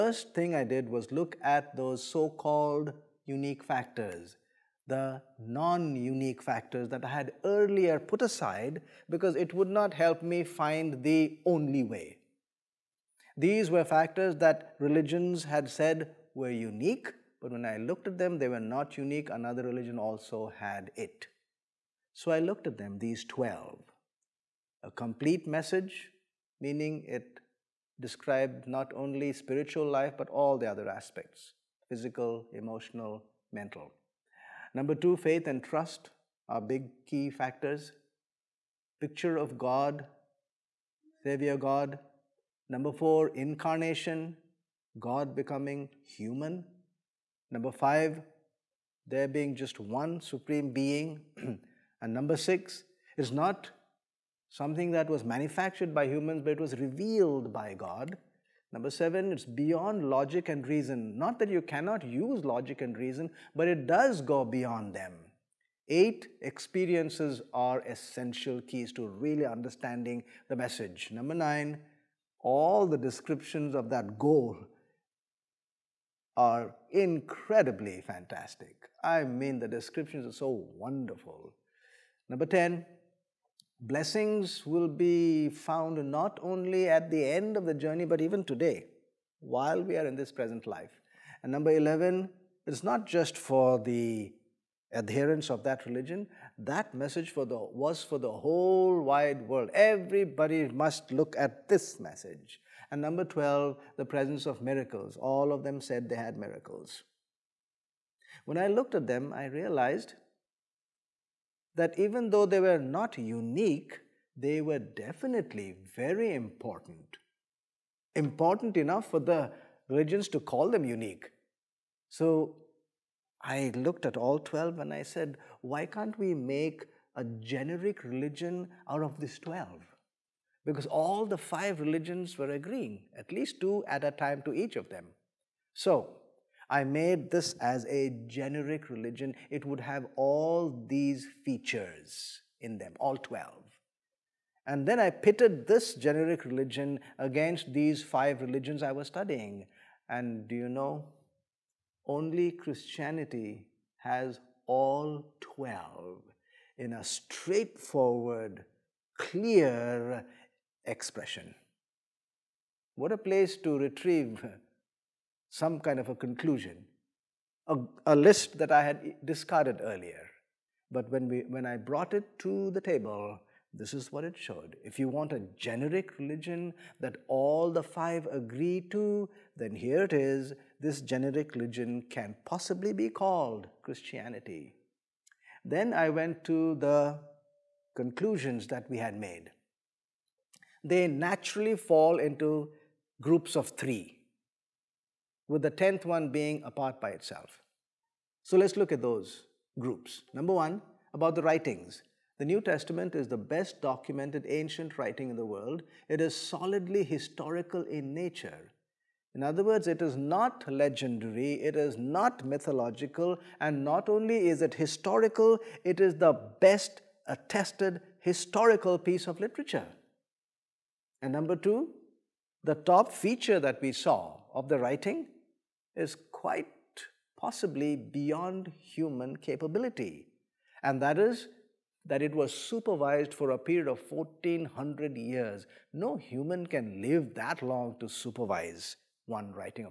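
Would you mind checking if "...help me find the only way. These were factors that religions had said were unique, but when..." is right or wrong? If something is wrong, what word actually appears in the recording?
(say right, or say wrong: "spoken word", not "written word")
right.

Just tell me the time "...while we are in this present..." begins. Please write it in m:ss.
1:29.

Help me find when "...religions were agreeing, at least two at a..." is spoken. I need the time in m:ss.
2:11.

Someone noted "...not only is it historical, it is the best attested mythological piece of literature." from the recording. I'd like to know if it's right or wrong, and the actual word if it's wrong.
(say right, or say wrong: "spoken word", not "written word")
wrong: "historical", not "mythological".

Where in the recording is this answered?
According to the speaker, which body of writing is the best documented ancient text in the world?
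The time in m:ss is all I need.
3:22.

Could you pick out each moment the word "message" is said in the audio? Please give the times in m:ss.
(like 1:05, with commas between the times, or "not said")
0:25, 1:10, 1:36, 1:41.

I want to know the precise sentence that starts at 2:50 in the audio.
But when, we, when I brought it to the table, this is what it showed.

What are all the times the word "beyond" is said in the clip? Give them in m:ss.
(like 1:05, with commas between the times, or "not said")
0:59, 1:04, 3:47.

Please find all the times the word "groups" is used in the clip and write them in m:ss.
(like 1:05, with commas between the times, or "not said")
3:13, 3:19.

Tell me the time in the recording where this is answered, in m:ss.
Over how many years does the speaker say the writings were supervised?
3:54.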